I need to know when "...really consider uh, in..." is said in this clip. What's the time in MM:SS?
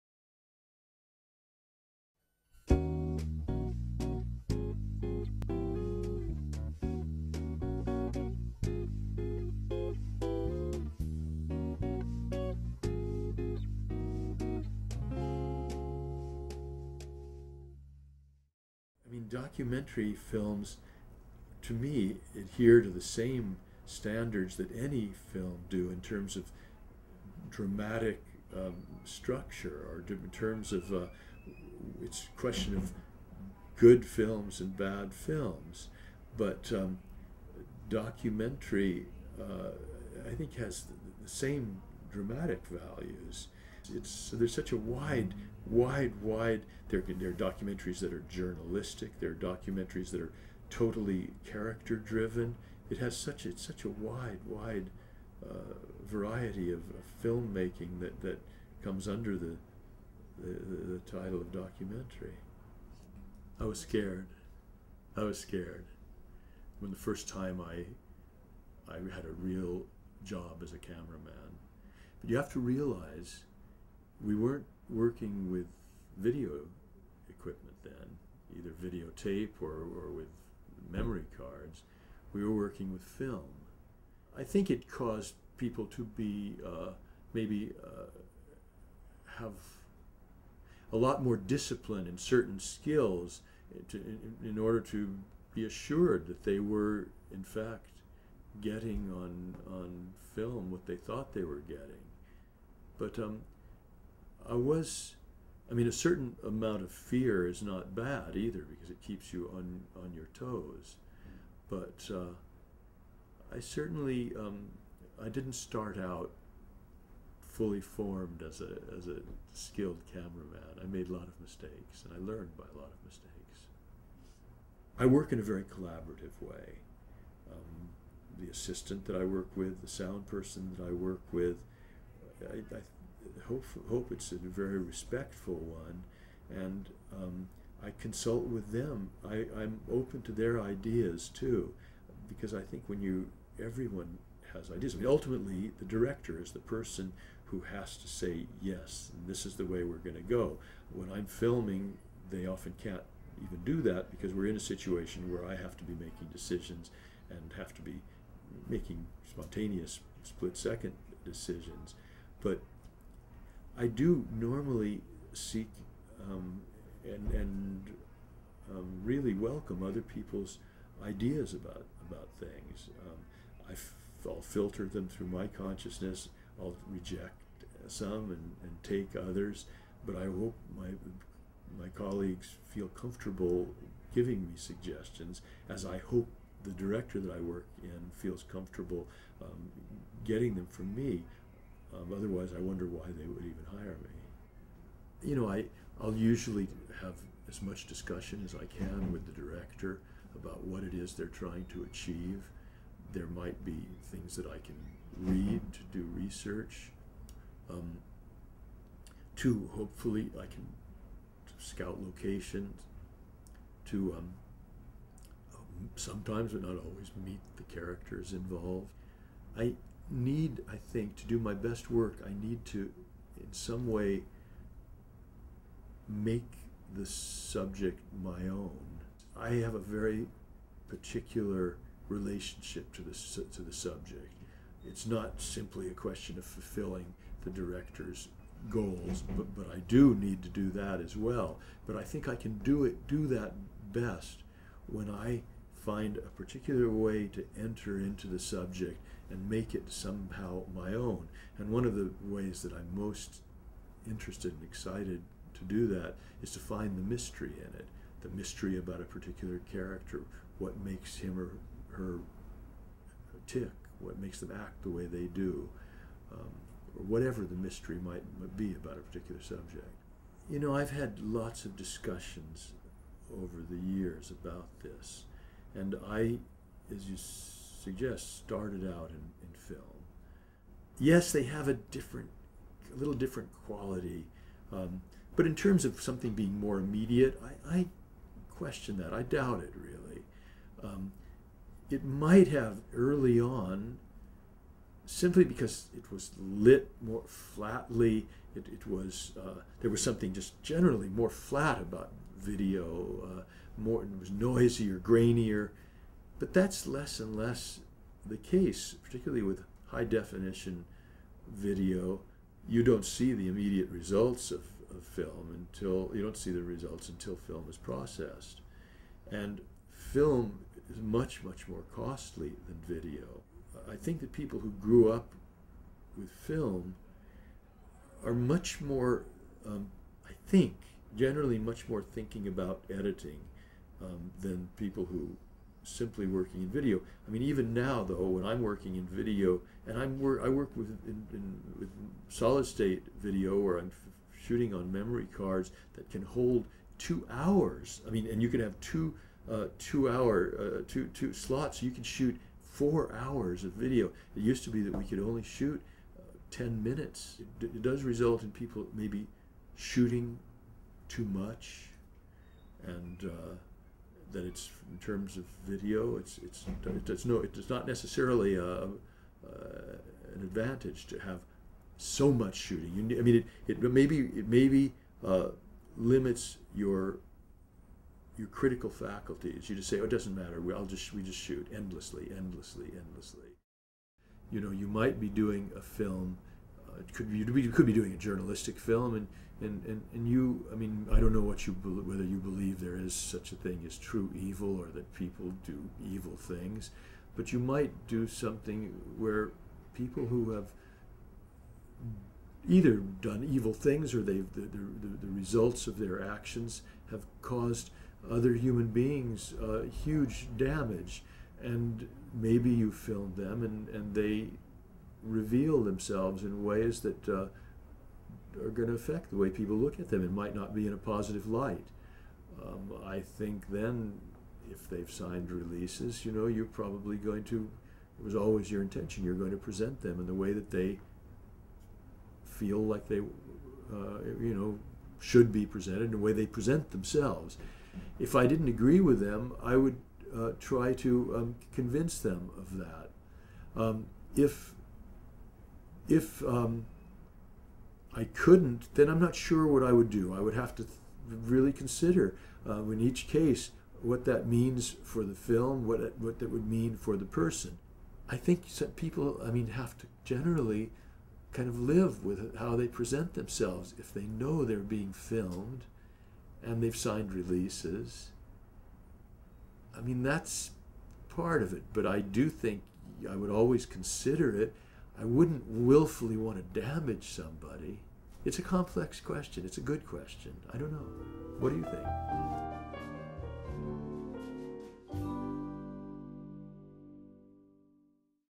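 07:31.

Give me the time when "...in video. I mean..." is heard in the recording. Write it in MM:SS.
05:36.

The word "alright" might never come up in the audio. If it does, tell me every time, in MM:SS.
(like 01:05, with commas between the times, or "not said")
not said.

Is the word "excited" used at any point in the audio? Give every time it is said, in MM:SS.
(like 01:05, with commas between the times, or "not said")
04:14.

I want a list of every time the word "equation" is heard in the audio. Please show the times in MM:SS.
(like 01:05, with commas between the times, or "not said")
not said.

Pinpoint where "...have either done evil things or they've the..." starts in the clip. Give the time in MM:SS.
06:40.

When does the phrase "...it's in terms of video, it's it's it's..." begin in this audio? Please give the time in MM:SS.
06:04.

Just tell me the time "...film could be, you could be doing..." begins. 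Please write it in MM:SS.
06:25.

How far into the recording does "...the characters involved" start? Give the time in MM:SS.
03:37.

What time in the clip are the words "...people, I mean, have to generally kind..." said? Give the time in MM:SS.
07:38.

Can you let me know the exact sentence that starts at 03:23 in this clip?
There might be things that I can read to do research.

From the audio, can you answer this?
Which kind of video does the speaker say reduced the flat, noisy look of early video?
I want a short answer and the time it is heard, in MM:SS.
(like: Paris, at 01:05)
high definition video, at 05:09.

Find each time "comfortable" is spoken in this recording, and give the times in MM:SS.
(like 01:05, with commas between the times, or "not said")
03:02, 03:08.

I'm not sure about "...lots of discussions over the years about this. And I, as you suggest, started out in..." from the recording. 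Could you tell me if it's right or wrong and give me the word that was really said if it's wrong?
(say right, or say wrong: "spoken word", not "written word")
right.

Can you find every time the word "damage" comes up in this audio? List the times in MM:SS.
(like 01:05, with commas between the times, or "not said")
06:50, 07:56.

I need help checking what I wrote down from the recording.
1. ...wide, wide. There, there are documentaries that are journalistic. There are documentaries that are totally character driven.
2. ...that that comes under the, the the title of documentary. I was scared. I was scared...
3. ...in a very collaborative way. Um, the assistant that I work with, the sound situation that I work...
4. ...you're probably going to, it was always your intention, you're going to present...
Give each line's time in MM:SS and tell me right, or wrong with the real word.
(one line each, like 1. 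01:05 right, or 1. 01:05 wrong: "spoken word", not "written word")
1. 00:45 right
2. 00:57 right
3. 02:05 wrong: "person", not "situation"
4. 07:06 right.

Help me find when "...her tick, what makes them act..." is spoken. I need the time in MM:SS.
04:21.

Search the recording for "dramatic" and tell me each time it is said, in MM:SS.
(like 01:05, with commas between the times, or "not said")
00:27, 00:42.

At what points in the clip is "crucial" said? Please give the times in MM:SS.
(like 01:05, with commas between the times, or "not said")
not said.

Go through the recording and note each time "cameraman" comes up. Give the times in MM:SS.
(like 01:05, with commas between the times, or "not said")
01:10, 02:00.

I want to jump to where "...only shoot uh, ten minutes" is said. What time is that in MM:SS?
05:55.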